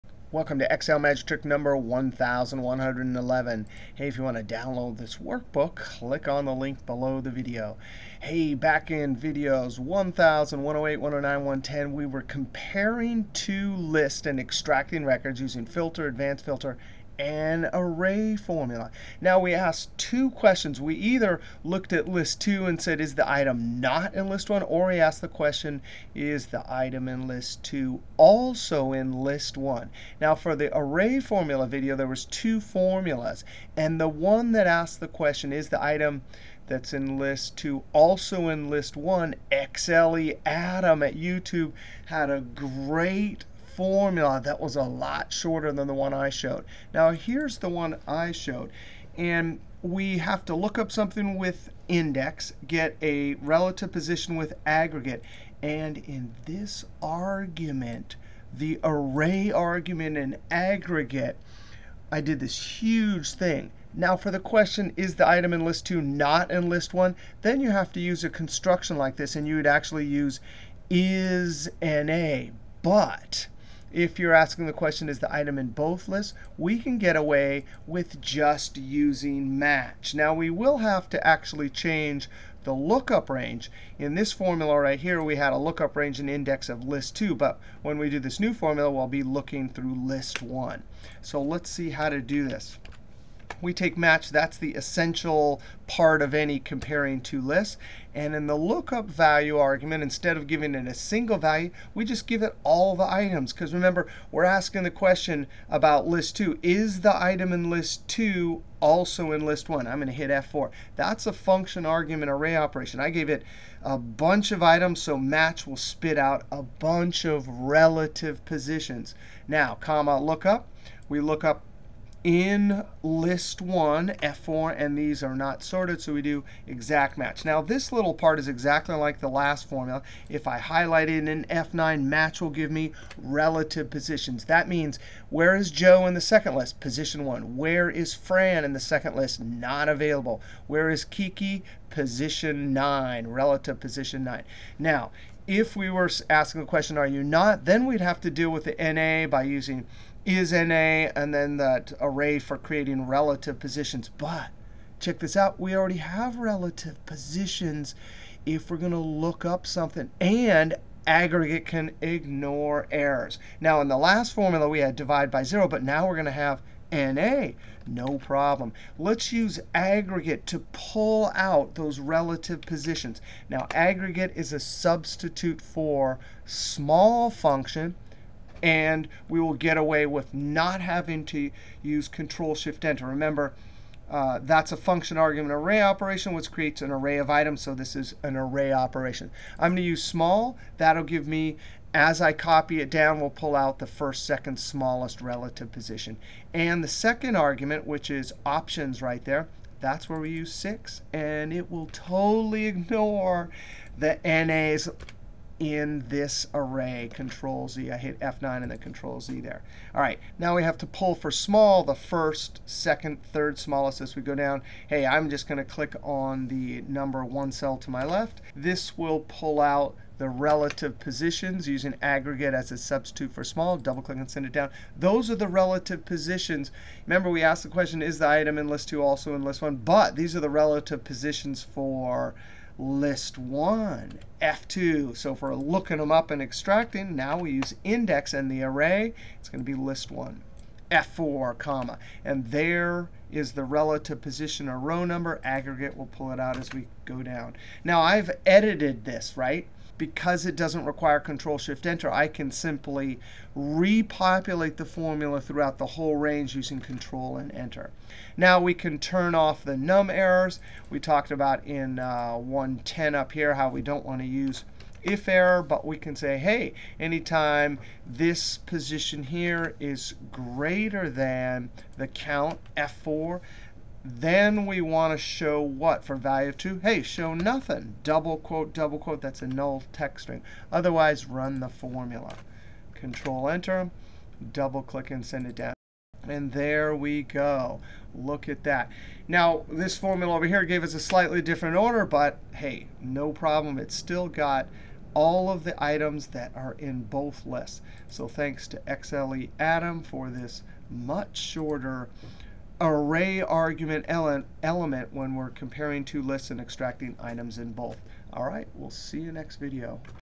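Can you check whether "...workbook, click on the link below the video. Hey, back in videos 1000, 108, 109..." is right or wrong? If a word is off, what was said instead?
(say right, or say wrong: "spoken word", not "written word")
right.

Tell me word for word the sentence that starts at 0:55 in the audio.
And in this argument, the array argument and aggregate, I did this huge thing.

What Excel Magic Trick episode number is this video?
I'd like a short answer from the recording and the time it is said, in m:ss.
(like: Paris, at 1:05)
1111, at 0:01.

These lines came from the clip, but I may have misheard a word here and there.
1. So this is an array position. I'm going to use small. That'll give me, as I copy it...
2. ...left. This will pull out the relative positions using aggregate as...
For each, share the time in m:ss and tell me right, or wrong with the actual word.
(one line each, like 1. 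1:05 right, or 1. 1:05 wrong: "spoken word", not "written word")
1. 3:07 wrong: "operation", not "position"
2. 3:38 right.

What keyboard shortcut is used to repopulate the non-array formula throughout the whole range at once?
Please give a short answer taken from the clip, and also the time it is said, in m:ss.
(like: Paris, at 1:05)
Control Enter, at 4:16.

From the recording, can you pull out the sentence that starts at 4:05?
Aggregate, will pull it out as we go down.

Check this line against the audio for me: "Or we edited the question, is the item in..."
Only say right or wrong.
wrong.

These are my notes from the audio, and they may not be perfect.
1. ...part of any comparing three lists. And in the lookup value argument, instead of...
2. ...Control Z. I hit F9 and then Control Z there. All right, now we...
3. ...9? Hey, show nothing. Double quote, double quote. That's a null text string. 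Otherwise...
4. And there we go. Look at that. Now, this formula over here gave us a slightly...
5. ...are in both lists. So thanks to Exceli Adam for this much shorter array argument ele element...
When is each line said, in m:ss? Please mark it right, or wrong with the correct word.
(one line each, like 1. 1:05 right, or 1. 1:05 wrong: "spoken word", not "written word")
1. 1:35 wrong: "two", not "three"
2. 3:27 right
3. 4:36 wrong: "2", not "9"
4. 4:46 right
5. 4:56 right.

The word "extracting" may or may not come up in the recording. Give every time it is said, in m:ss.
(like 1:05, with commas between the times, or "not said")
0:14, 3:56, 5:06.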